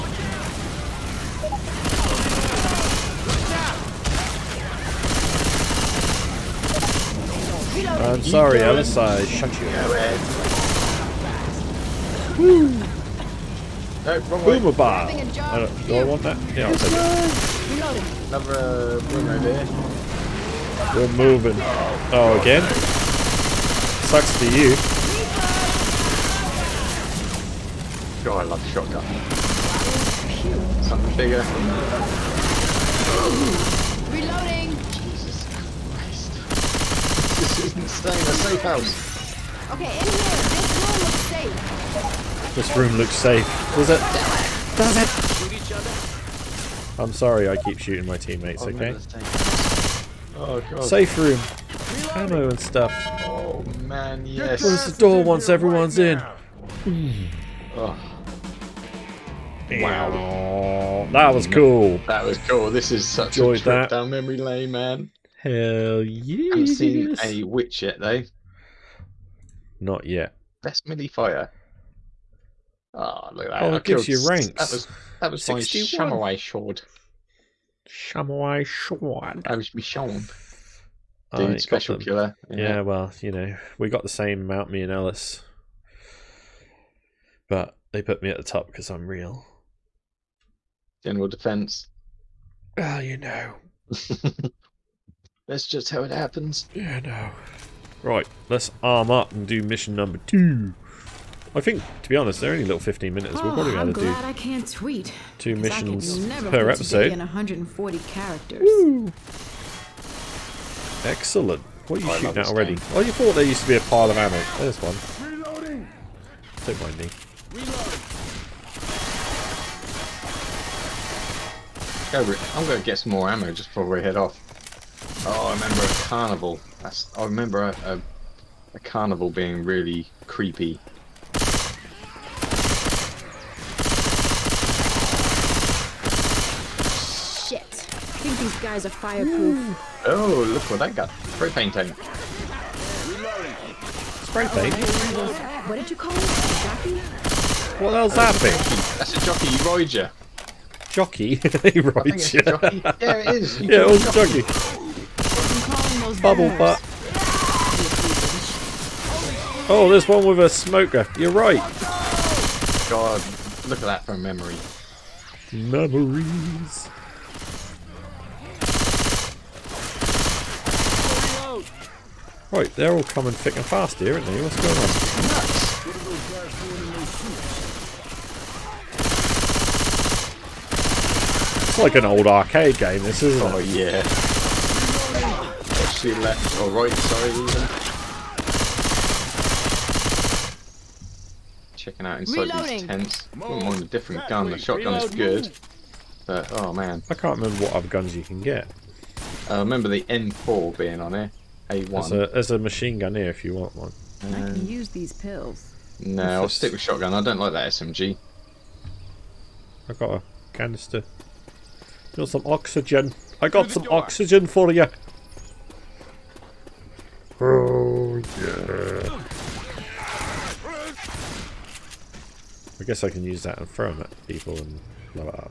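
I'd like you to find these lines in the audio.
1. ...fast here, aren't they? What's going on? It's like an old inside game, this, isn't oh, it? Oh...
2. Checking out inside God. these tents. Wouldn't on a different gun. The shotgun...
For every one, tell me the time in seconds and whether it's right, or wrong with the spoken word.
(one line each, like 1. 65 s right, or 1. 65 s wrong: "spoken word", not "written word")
1. 173 s wrong: "arcade", not "inside"
2. 191 s wrong: "Reloading", not "God".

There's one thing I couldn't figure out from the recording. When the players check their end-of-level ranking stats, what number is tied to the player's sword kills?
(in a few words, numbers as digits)
61.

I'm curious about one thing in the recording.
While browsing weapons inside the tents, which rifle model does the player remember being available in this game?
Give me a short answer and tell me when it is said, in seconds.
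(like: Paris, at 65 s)
M4, at 200 s.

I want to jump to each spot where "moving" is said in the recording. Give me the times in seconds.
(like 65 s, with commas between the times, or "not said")
21 s.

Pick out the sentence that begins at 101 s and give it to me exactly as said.
I think, to be honest, they're only little 15 minutes.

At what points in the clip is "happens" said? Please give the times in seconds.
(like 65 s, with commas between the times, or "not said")
96 s.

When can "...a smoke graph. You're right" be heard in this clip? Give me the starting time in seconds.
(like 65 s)
160 s.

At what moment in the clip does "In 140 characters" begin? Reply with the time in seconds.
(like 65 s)
107 s.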